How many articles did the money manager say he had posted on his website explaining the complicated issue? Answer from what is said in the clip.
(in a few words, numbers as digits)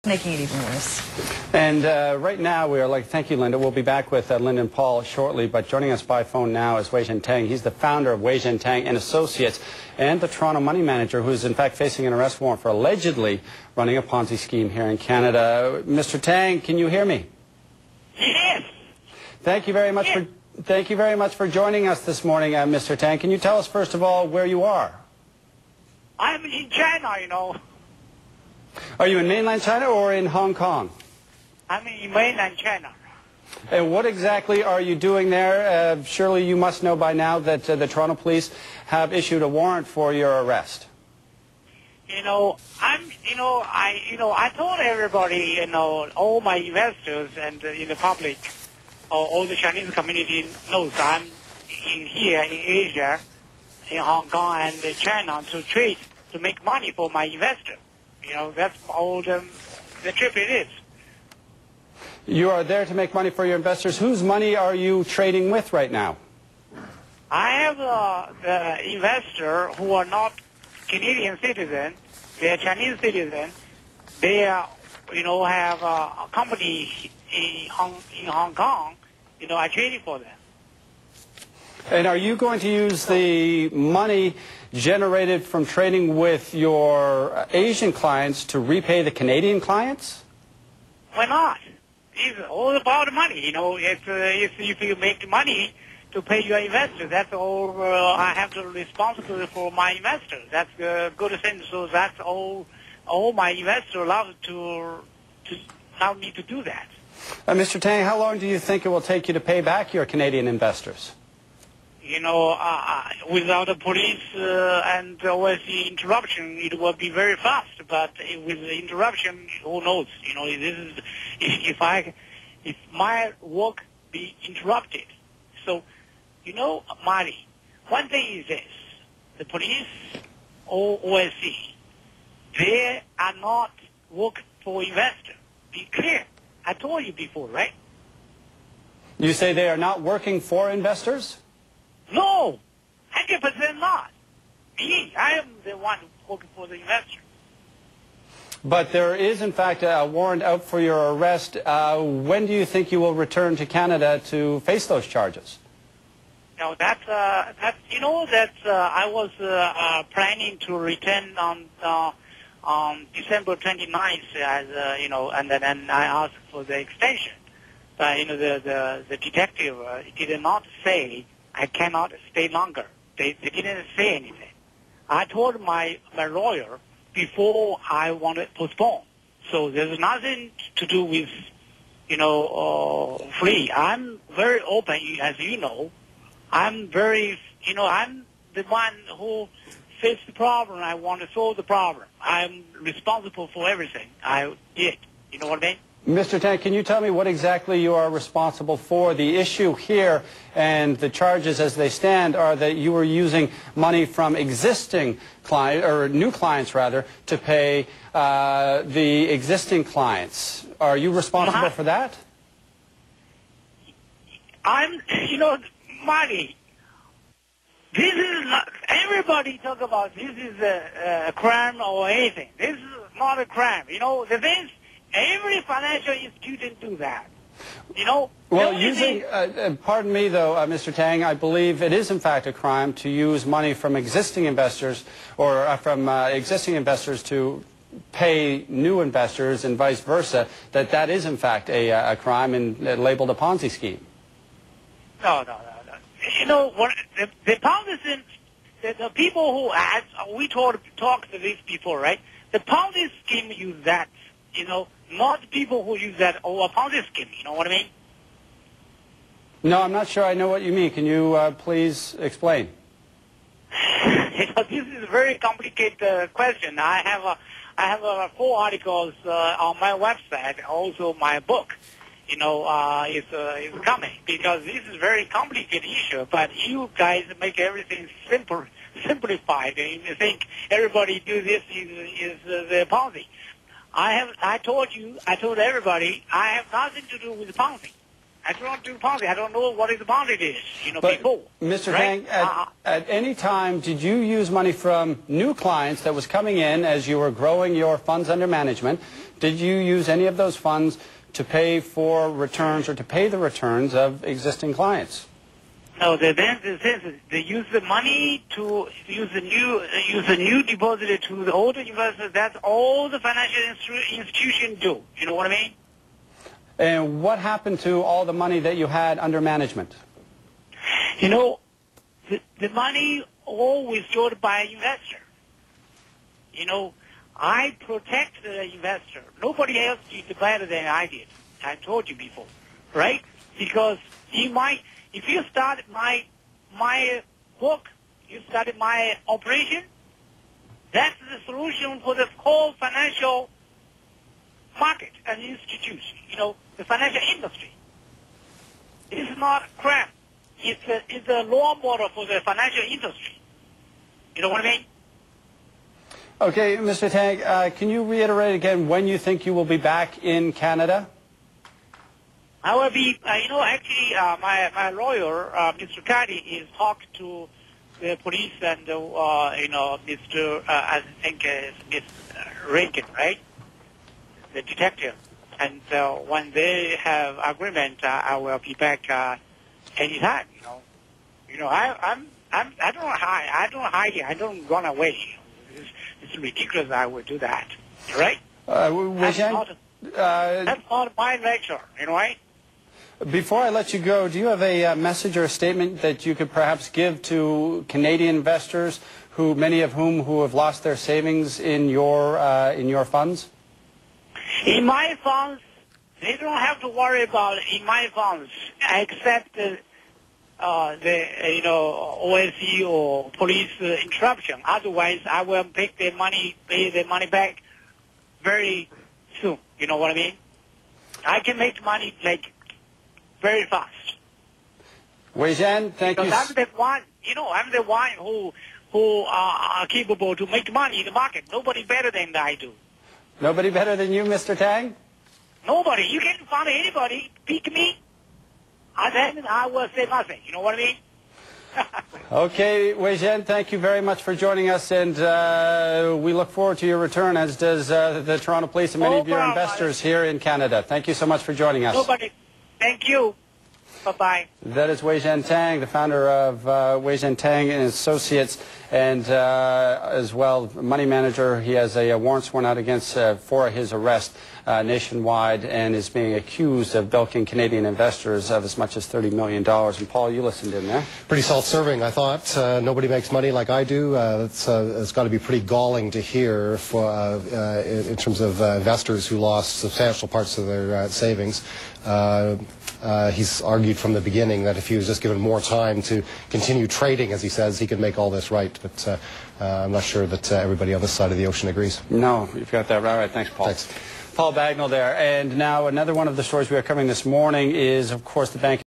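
4.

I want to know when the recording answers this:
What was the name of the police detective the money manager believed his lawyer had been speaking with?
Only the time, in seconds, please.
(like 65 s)
371 s.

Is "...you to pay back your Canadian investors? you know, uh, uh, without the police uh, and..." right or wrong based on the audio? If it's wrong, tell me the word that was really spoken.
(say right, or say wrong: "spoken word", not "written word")
right.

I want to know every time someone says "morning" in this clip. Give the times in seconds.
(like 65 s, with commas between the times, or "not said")
22 s, 497 s.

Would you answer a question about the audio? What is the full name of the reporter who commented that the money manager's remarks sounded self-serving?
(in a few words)
Paul Bagnall.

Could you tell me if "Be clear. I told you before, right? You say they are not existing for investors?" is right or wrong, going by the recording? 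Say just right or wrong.
wrong.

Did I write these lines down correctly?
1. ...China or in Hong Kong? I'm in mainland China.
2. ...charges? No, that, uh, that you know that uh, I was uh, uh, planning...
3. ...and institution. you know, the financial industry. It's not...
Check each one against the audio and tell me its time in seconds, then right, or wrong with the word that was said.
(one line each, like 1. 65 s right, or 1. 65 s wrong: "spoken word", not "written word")
1. 29 s right
2. 155 s right
3. 345 s right.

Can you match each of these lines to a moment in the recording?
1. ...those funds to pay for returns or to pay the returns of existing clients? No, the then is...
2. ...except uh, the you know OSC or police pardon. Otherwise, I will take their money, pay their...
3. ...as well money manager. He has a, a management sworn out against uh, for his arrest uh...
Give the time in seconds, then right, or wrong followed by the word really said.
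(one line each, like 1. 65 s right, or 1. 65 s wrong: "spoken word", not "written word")
1. 300 s right
2. 408 s wrong: "interruption", not "pardon"
3. 460 s wrong: "warrant", not "management".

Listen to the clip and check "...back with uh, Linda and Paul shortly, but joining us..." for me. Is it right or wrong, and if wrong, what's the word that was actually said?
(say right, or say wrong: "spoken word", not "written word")
right.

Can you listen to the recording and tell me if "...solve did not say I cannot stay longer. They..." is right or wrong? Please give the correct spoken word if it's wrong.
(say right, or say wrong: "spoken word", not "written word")
wrong: "detective", not "solve".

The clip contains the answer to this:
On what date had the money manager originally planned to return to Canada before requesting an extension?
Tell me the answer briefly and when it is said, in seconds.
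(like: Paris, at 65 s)
December 29th, at 163 s.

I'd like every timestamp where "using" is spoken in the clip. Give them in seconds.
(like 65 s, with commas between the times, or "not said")
203 s, 228 s.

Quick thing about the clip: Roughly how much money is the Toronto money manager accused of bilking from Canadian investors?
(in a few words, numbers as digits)
$30 million.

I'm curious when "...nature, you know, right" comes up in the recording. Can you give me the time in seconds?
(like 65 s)
391 s.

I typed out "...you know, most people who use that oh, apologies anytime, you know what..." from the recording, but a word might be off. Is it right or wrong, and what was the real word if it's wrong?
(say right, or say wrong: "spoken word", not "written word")
wrong: "scheme", not "anytime".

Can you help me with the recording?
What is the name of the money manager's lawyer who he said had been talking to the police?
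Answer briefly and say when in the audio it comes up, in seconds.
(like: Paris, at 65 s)
Mr. Caddy, at 365 s.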